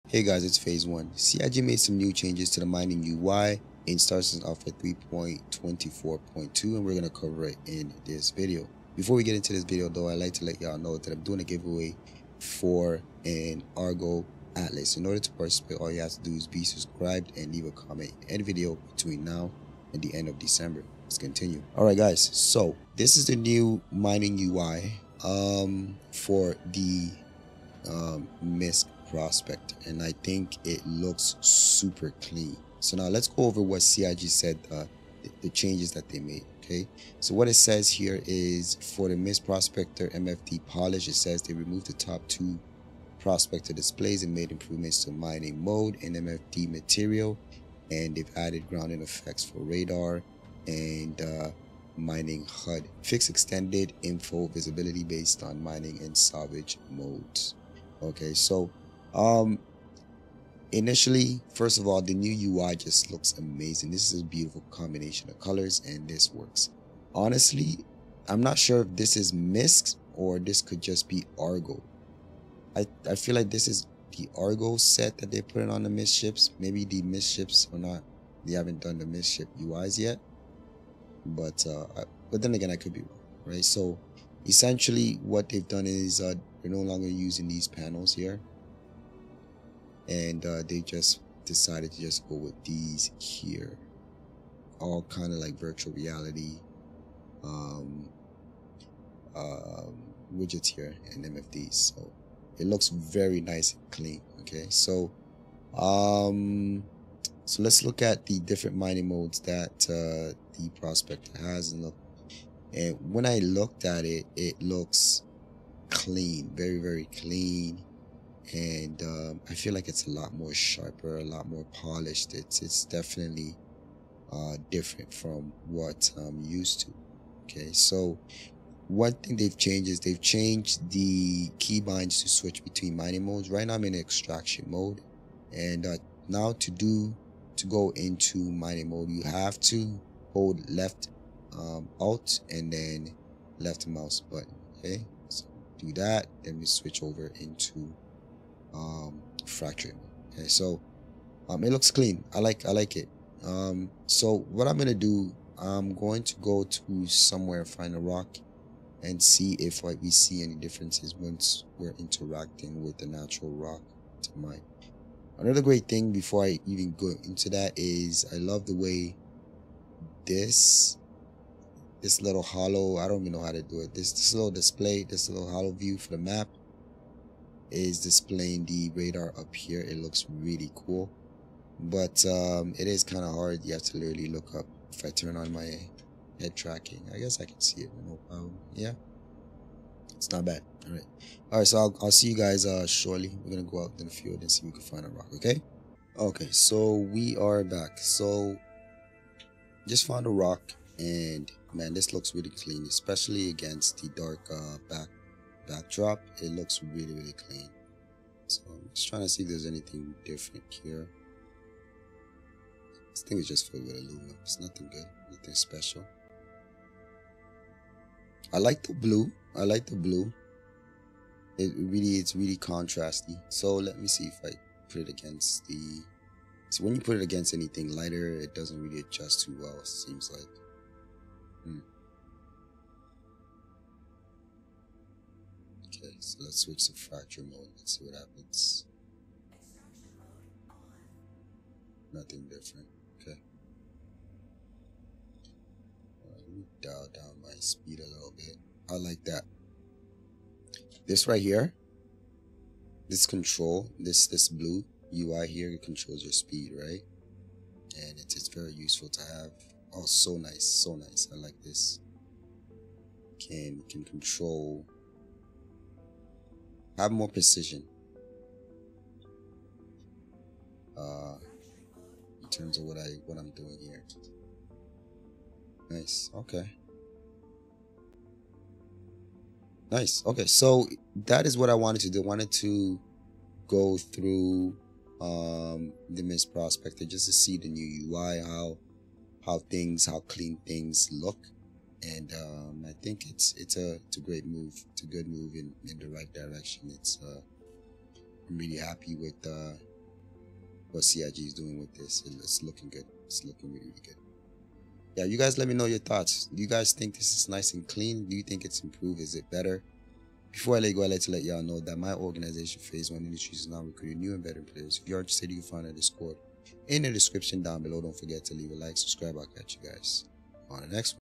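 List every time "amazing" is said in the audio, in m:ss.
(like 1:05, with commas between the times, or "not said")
1:03.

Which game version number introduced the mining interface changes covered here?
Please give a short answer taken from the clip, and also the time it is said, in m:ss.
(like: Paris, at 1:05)
3.24.2, at 0:04.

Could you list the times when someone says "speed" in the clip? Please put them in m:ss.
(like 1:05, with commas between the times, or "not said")
4:07, 4:16.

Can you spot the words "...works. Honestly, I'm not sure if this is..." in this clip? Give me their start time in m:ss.
1:06.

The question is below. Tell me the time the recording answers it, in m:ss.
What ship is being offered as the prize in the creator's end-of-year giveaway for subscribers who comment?
0:13.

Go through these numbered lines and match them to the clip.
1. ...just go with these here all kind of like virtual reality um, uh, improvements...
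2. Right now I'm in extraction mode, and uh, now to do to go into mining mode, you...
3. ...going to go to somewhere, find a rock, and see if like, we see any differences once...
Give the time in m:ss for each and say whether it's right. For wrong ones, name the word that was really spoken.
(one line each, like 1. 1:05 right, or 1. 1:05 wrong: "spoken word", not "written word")
1. 1:32 wrong: "widgets", not "improvements"
2. 2:13 right
3. 2:35 right.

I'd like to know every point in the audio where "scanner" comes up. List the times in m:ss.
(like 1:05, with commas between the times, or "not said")
not said.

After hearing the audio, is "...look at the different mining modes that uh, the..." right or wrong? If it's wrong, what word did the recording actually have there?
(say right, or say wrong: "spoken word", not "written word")
right.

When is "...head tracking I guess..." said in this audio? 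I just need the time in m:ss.
3:06.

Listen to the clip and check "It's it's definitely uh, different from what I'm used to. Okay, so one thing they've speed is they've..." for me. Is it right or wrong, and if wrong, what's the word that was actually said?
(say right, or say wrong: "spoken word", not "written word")
wrong: "changed", not "speed".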